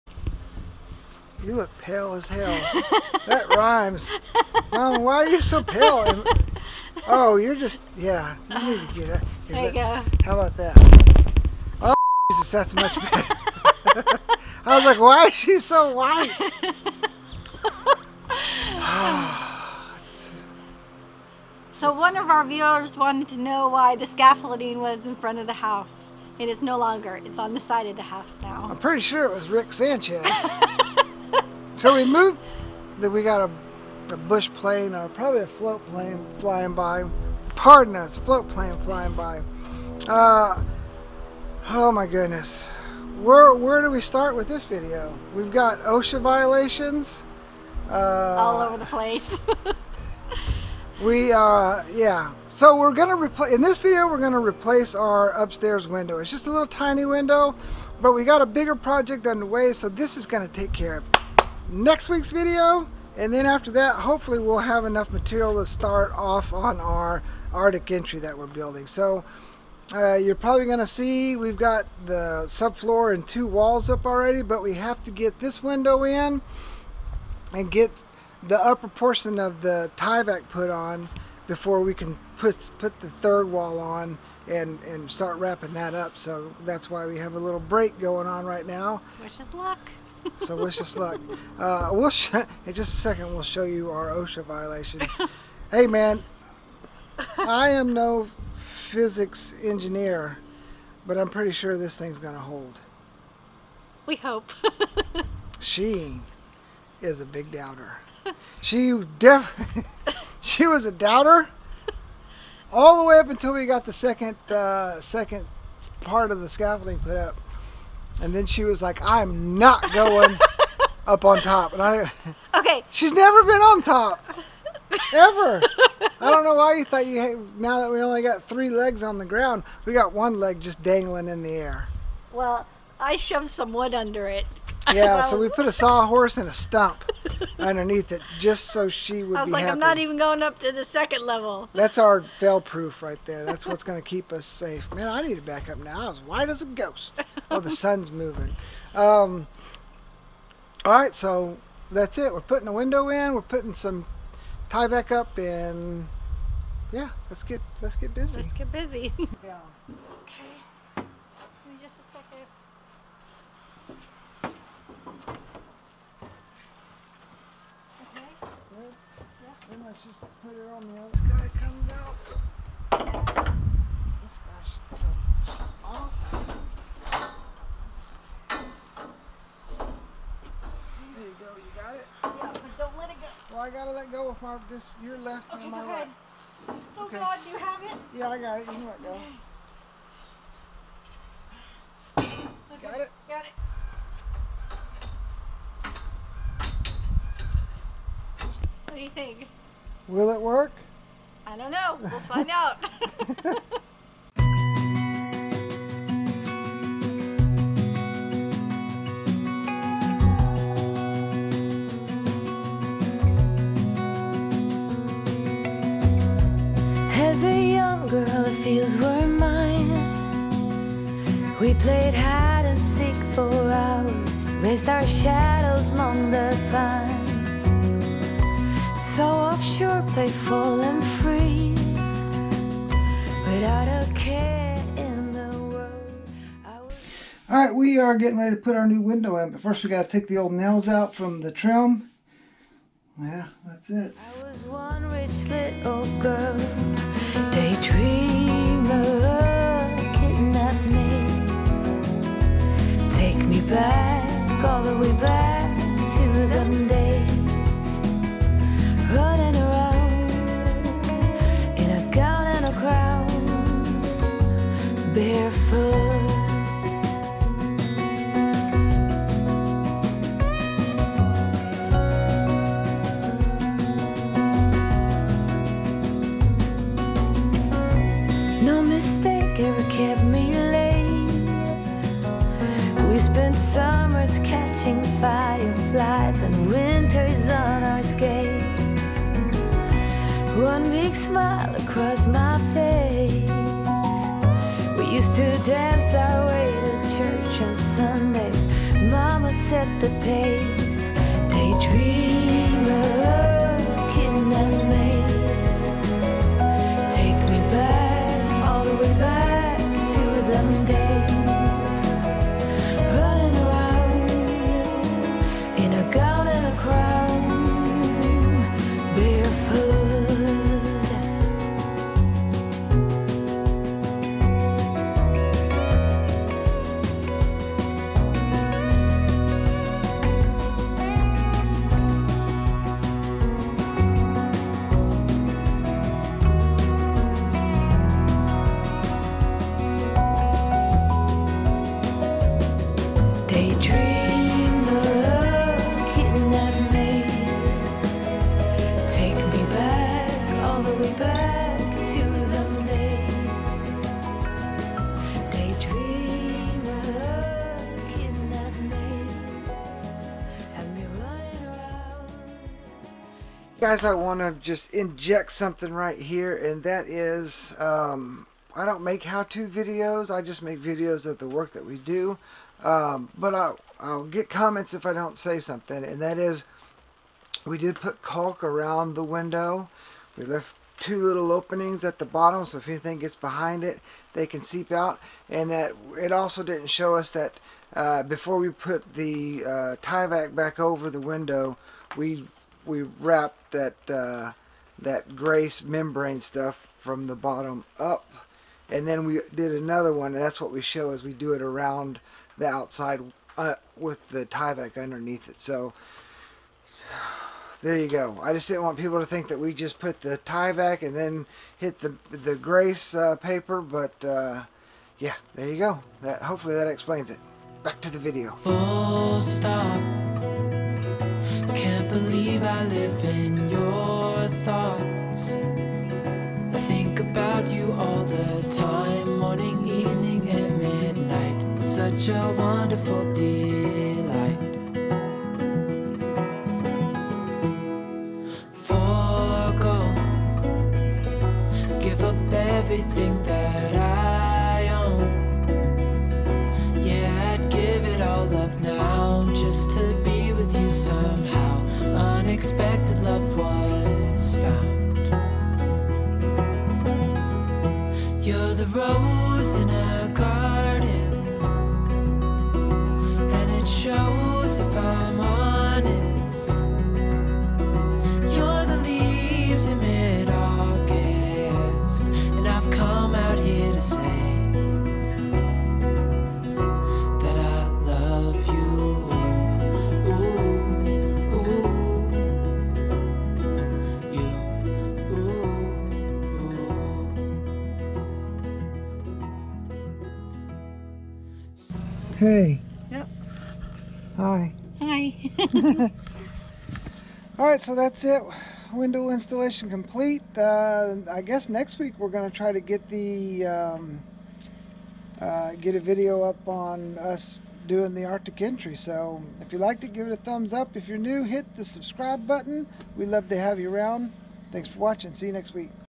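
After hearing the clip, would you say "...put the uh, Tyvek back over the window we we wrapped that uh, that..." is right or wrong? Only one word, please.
right.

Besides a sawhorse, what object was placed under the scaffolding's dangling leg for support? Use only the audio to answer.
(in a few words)
A stump.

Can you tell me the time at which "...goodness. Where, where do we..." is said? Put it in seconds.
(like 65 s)
42 s.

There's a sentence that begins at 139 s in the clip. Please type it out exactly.
I'm not even going up to the second level.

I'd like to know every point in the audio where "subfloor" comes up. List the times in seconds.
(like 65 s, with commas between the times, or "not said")
72 s.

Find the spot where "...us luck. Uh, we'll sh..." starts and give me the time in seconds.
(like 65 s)
90 s.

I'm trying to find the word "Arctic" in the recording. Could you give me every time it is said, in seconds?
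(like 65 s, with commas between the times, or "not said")
67 s, 508 s.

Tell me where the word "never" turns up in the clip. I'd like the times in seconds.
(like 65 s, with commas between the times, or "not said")
123 s.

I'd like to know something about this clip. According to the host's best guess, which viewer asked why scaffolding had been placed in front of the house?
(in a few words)
Rick Sanchez.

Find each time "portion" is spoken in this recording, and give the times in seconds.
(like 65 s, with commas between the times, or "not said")
78 s.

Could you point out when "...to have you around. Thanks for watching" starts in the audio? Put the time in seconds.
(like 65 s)
513 s.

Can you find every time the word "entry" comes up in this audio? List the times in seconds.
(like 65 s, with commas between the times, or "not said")
67 s, 508 s.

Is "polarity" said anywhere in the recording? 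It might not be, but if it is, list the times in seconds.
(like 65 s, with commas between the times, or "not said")
not said.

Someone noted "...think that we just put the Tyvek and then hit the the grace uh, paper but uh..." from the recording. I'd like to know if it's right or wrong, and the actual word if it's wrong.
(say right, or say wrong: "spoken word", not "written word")
right.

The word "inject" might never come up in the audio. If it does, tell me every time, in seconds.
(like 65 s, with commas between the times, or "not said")
364 s.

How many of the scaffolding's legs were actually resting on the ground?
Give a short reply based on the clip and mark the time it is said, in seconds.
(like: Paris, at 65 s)
3, at 128 s.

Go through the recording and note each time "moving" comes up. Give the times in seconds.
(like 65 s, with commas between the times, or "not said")
148 s.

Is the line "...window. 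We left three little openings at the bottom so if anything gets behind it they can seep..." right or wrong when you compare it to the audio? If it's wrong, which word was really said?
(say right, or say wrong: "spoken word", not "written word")
wrong: "two", not "three".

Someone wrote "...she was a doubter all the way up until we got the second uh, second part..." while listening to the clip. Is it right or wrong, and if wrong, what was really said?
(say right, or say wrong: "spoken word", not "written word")
right.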